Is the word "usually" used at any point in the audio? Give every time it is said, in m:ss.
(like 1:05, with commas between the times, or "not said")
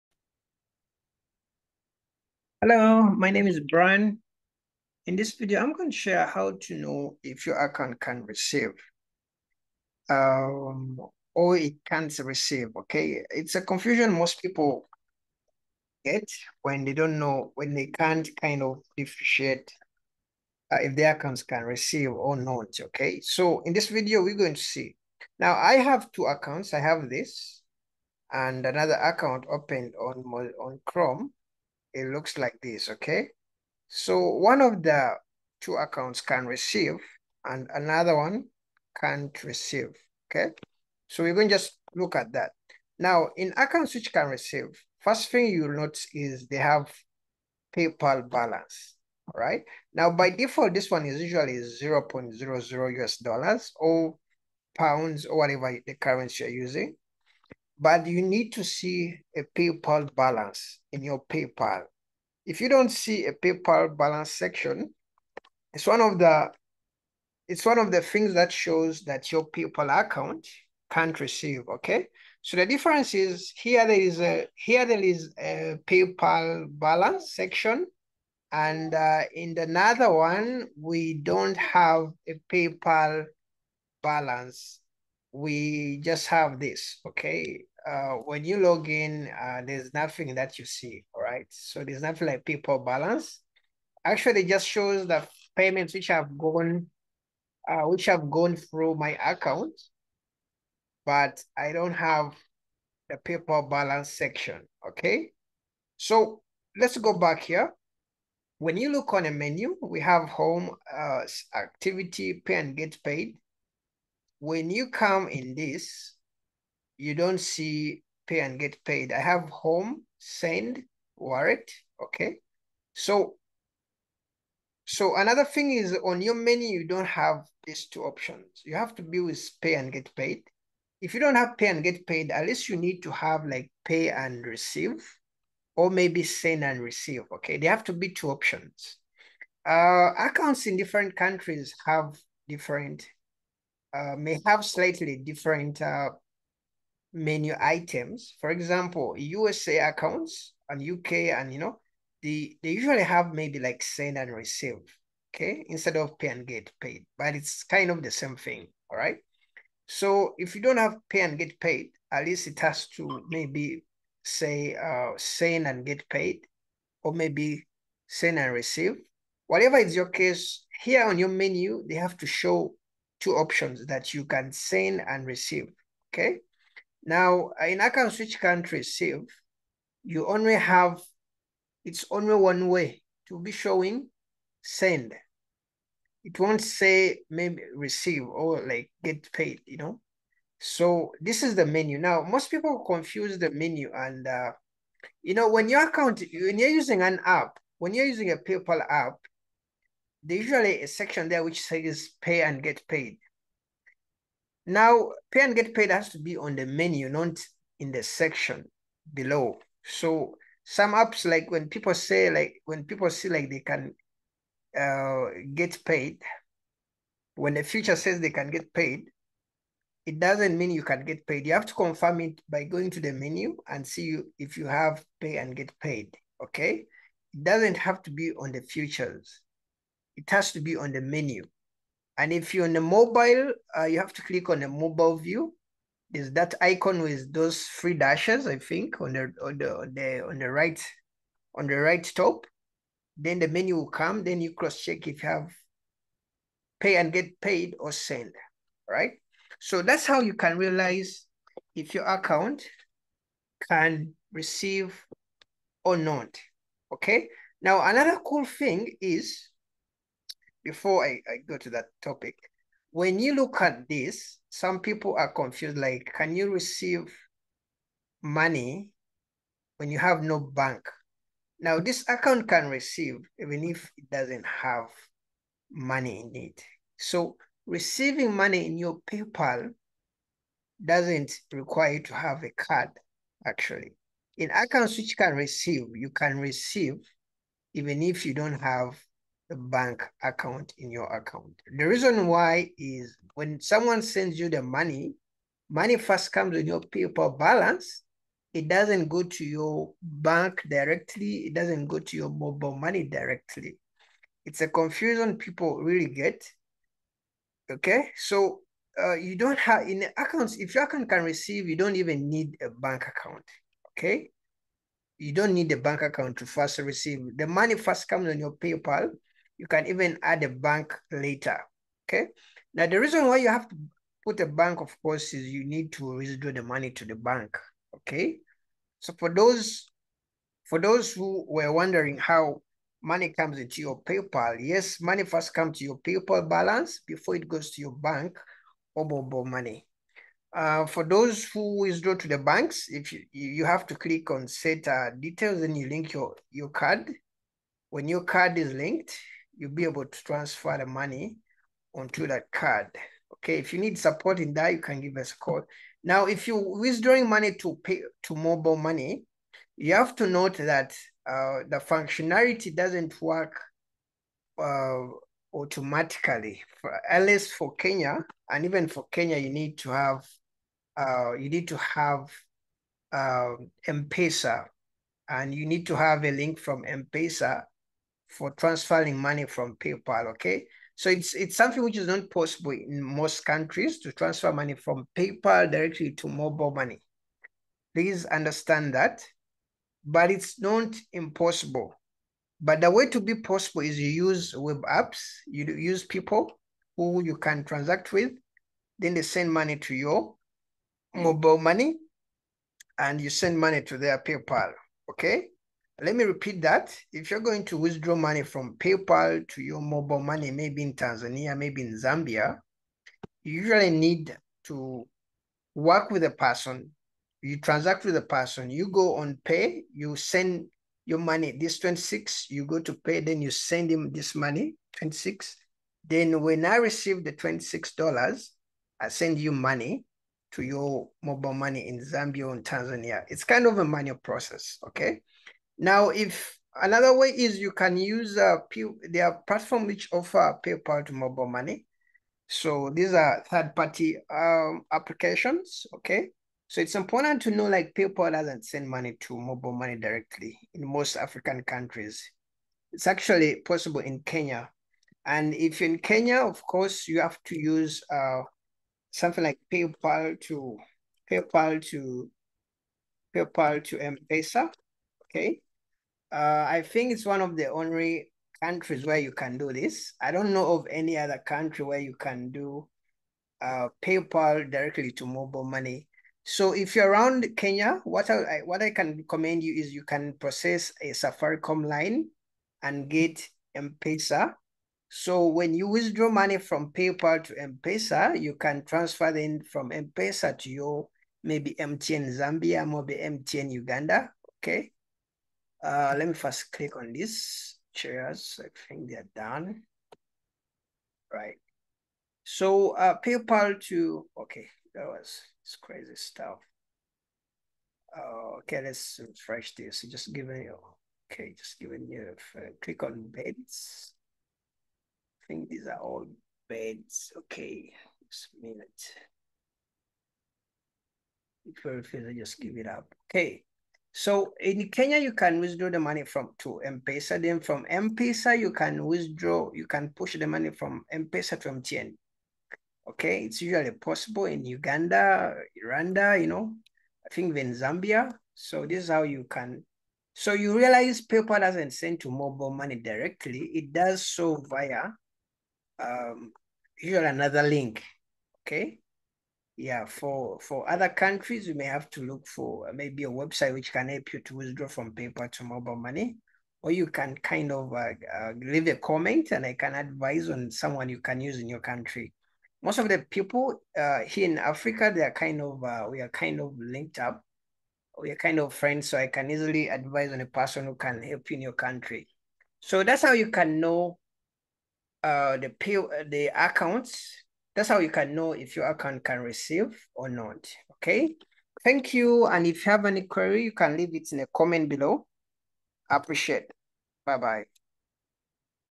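0:51, 2:32, 3:20, 6:53, 8:53, 9:07.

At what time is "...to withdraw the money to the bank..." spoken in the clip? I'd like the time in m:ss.
5:25.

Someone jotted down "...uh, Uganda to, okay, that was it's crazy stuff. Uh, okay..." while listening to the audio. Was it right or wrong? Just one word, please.
wrong.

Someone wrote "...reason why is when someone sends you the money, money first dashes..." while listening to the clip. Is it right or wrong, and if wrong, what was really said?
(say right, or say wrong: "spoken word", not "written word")
wrong: "comes", not "dashes".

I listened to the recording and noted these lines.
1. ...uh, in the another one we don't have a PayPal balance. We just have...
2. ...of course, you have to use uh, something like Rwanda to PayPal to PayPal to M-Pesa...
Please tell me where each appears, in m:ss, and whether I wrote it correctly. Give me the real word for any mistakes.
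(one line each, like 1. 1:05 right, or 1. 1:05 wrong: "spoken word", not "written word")
1. 1:18 right
2. 7:36 wrong: "PayPal", not "Rwanda".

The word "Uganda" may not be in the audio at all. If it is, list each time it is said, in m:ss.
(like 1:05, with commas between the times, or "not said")
8:13, 8:54.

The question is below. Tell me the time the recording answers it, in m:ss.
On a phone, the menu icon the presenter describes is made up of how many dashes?
3:57.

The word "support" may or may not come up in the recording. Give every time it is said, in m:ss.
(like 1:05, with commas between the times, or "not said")
5:53.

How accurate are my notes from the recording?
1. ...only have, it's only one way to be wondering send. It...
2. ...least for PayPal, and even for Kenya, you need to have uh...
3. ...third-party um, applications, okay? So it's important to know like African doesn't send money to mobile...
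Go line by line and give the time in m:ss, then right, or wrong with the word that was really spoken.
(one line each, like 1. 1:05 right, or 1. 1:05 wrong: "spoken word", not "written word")
1. 3:00 wrong: "showing", not "wondering"
2. 6:07 wrong: "Kenya", not "PayPal"
3. 7:23 wrong: "PayPal", not "African".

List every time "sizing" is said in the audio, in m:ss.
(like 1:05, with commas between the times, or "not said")
not said.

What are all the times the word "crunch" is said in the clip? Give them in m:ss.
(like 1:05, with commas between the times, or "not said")
not said.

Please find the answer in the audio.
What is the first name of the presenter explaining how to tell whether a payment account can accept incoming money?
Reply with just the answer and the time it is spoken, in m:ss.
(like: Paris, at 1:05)
Brian, at 0:03.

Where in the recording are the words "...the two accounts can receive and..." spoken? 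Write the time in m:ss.
0:34.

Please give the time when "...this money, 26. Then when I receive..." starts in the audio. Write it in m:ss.
7:04.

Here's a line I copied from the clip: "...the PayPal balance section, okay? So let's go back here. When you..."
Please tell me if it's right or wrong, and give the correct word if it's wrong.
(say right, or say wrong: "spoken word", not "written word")
right.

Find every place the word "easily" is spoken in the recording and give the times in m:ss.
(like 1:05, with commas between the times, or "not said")
9:29.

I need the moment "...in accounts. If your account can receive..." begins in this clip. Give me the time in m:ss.
5:09.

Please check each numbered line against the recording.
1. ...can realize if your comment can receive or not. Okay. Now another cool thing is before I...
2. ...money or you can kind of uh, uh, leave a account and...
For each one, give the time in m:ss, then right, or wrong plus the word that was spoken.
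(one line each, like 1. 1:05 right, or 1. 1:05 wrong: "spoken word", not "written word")
1. 4:10 wrong: "account", not "comment"
2. 9:15 wrong: "comment", not "account".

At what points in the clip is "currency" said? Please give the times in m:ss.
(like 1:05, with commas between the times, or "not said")
0:55.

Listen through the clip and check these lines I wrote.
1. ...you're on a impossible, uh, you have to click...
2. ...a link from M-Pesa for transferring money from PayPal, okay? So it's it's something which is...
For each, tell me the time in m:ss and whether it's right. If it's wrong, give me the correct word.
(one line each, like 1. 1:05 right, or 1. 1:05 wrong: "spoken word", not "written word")
1. 3:52 wrong: "mobile", not "impossible"
2. 6:16 right.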